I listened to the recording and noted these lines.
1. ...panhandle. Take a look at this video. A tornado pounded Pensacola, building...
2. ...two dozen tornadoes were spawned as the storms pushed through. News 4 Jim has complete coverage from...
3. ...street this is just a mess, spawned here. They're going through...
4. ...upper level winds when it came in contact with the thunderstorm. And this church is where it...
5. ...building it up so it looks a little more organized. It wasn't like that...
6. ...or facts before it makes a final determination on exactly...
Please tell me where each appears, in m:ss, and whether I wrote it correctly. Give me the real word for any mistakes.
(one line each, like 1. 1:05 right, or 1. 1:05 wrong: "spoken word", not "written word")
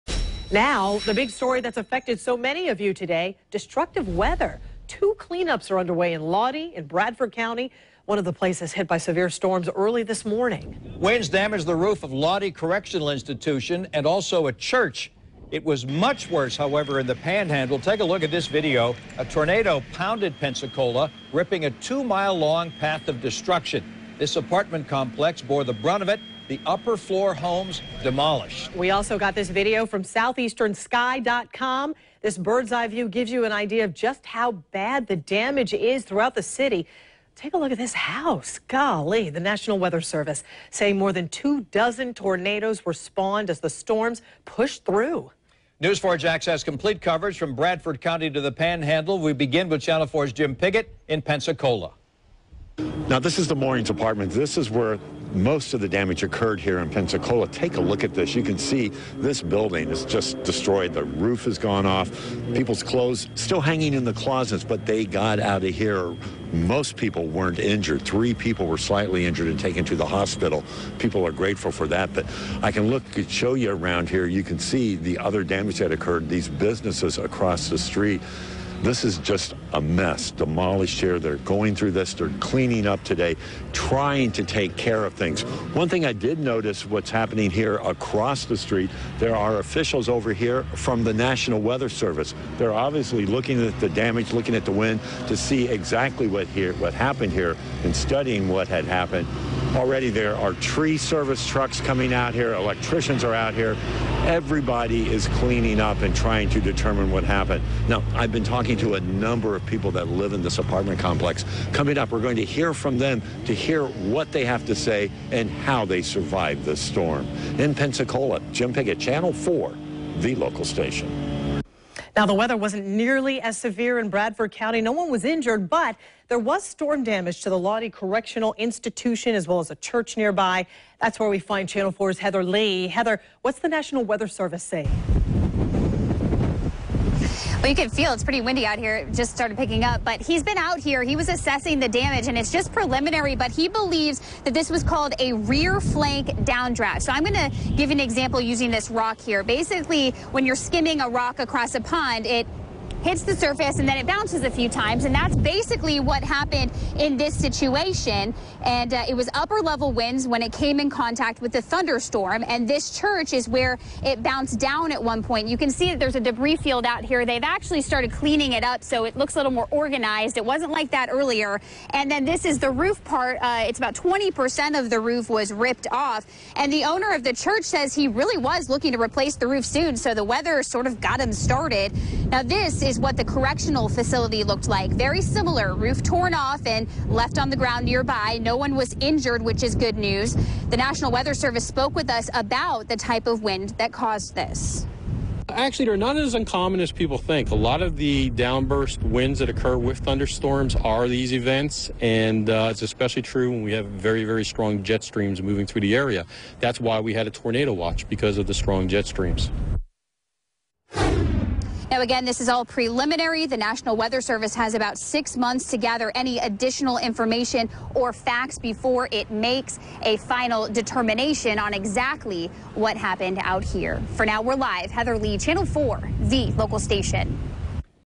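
1. 0:17 wrong: "ripping", not "building"
2. 0:41 wrong: "Jax", not "Jim"
3. 1:17 wrong: "demolished", not "spawned"
4. 2:39 right
5. 2:48 wrong: "cleaning", not "building"
6. 3:37 right.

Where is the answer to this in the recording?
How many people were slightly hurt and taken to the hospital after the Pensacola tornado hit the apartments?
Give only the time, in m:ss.
1:08.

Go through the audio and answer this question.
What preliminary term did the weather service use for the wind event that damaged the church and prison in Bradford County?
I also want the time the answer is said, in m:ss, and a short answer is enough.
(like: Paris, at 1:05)
Rear flank downdraft, at 2:25.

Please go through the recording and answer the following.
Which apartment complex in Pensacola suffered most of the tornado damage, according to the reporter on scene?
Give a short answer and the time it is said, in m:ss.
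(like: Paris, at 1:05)
The Moorings, at 0:53.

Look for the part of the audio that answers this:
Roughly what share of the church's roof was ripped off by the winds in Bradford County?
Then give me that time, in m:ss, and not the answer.
2:53.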